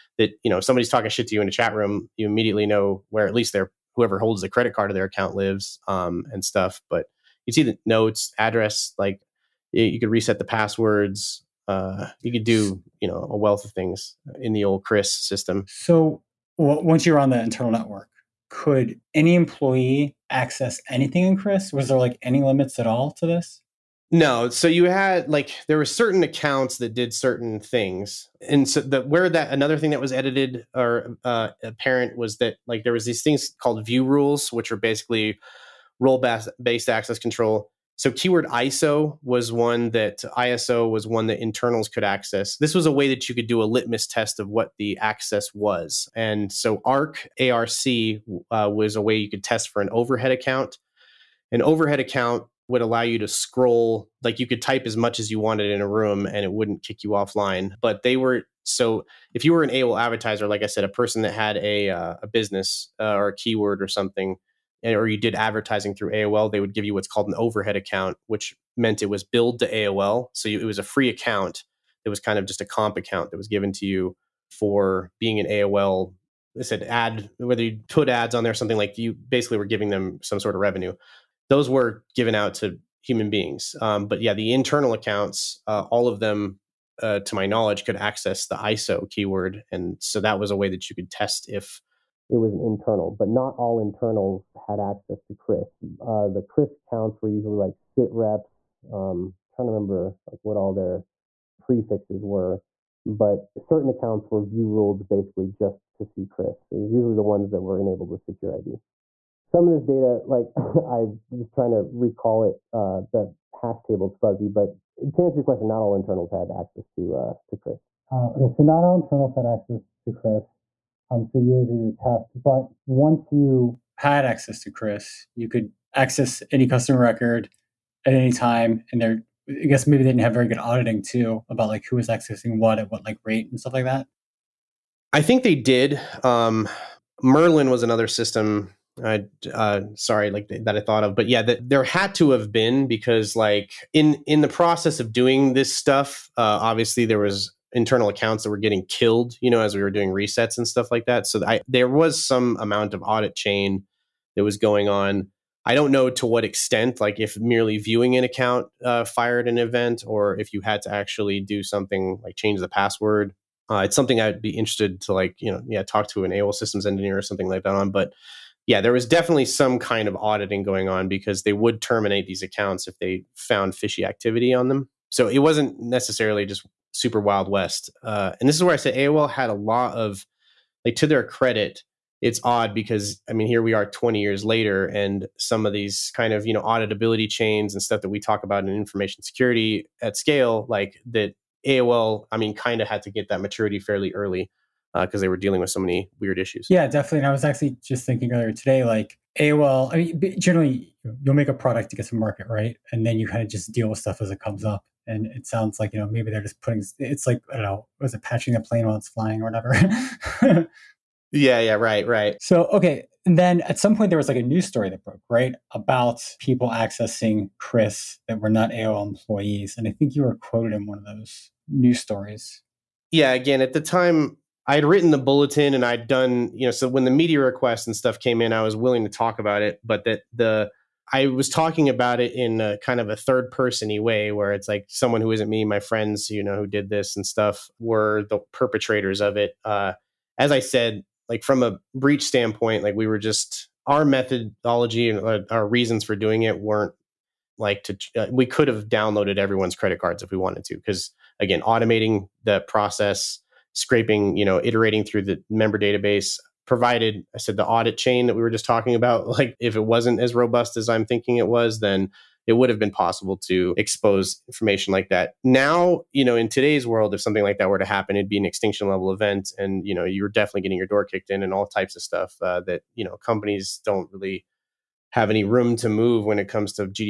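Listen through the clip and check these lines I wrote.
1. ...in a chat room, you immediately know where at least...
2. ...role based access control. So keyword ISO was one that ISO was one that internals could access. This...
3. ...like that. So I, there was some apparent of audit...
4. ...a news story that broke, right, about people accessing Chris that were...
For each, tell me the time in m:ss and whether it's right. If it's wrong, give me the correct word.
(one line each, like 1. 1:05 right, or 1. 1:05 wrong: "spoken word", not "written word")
1. 0:01 right
2. 0:35 right
3. 2:30 wrong: "amount", not "apparent"
4. 3:34 right.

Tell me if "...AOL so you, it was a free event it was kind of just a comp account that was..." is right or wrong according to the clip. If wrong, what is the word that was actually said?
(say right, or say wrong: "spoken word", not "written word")
wrong: "account", not "event".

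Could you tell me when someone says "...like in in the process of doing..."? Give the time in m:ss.
2:23.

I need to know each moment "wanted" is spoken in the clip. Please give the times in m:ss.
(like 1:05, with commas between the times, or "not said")
0:55, 4:10.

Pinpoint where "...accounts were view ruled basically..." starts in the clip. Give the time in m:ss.
1:43.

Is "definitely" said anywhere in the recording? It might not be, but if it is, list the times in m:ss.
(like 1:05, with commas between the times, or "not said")
2:49, 3:16, 4:30.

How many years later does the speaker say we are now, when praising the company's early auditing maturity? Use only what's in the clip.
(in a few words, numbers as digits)
20.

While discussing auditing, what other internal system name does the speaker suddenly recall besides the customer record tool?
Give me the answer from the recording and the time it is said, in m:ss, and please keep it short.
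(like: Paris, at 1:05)
Merlin, at 2:17.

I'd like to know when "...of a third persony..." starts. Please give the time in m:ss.
3:52.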